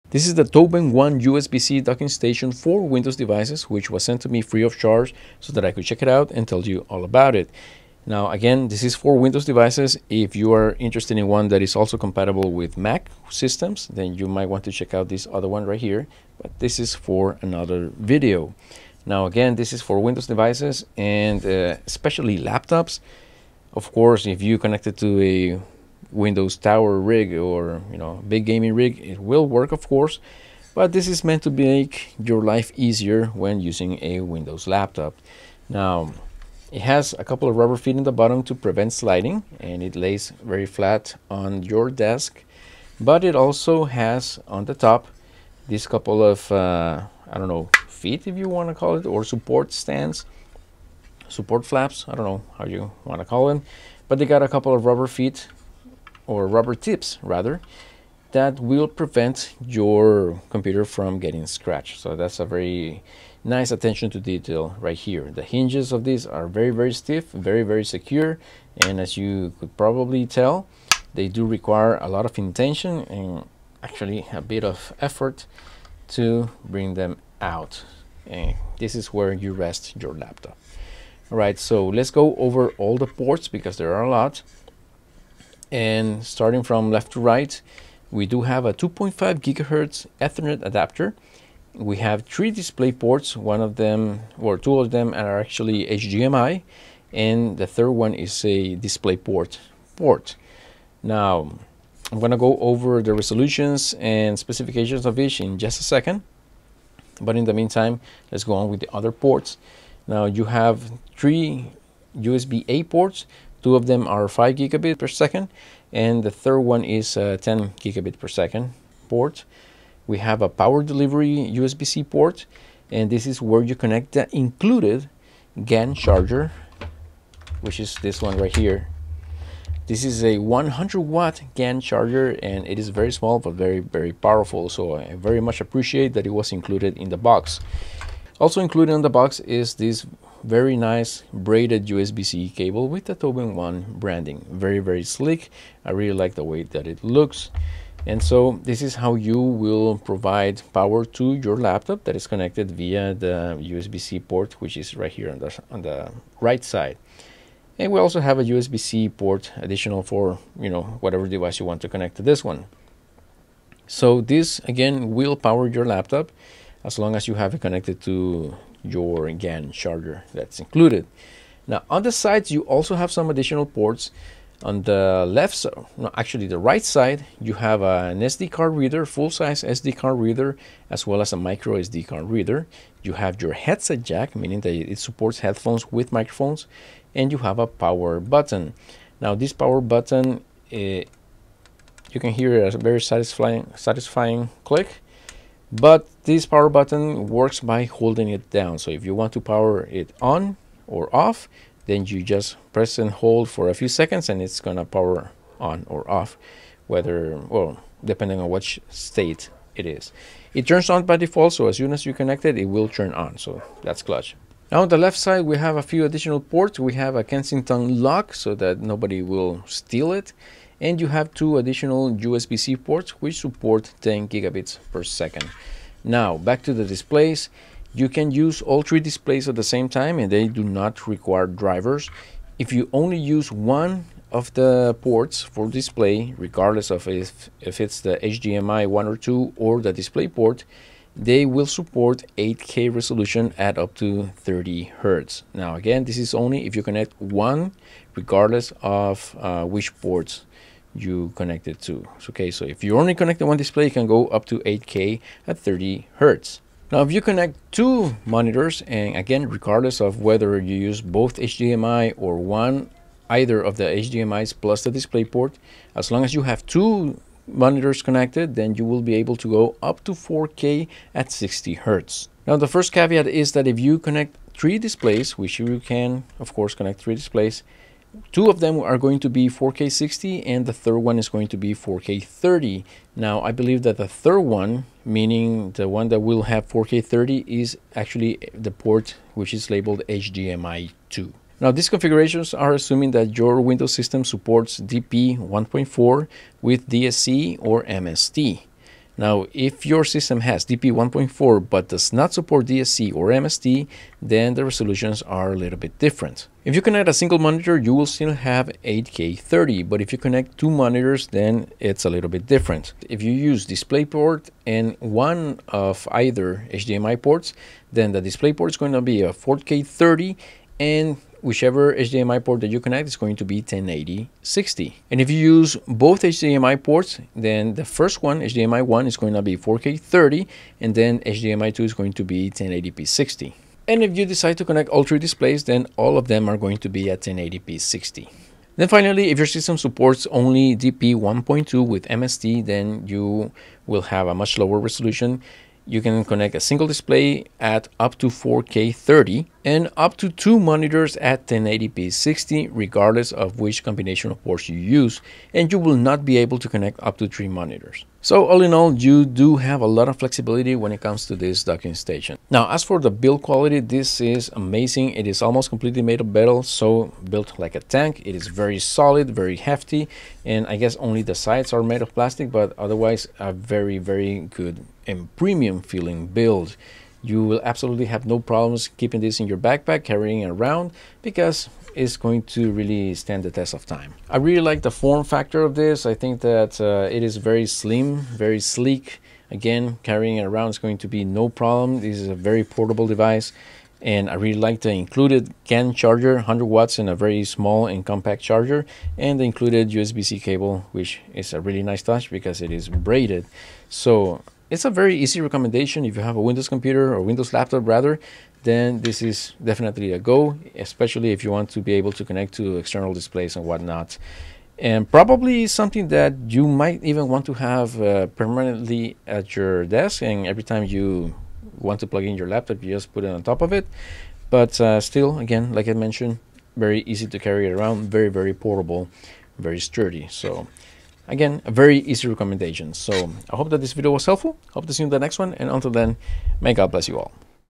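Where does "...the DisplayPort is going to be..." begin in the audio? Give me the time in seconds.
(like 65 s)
318 s.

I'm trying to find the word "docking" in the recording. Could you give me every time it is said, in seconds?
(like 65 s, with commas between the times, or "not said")
1 s, 361 s.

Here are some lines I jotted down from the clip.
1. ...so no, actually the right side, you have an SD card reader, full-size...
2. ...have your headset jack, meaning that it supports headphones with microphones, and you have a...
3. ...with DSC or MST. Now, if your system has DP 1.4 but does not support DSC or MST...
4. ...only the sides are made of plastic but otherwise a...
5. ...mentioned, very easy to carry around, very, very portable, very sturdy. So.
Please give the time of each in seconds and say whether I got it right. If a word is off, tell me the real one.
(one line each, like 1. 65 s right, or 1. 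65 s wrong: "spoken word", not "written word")
1. 175 s right
2. 183 s right
3. 296 s right
4. 370 s right
5. 425 s right.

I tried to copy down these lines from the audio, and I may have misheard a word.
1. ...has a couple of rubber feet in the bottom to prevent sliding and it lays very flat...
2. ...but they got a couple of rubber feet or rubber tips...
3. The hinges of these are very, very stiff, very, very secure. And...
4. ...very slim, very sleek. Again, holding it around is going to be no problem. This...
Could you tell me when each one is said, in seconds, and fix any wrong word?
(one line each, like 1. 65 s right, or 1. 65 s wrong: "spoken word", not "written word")
1. 36 s right
2. 54 s right
3. 65 s right
4. 387 s wrong: "carrying", not "holding".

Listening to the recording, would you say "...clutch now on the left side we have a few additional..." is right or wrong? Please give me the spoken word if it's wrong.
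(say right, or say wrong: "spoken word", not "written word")
right.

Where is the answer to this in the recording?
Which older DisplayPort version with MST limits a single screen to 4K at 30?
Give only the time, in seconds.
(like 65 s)
340 s.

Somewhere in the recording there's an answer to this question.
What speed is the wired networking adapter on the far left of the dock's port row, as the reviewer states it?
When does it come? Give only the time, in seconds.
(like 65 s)
88 s.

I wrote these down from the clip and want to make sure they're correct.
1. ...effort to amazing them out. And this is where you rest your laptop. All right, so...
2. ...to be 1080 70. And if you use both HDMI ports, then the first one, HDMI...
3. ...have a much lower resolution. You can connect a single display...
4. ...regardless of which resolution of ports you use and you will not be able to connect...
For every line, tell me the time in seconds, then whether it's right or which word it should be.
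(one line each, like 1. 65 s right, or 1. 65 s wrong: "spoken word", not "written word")
1. 75 s wrong: "bring", not "amazing"
2. 323 s wrong: "60", not "70"
3. 344 s right
4. 352 s wrong: "combination", not "resolution".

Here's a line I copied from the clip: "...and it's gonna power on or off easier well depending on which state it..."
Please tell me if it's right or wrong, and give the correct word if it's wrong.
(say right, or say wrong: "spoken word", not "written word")
wrong: "whether", not "easier".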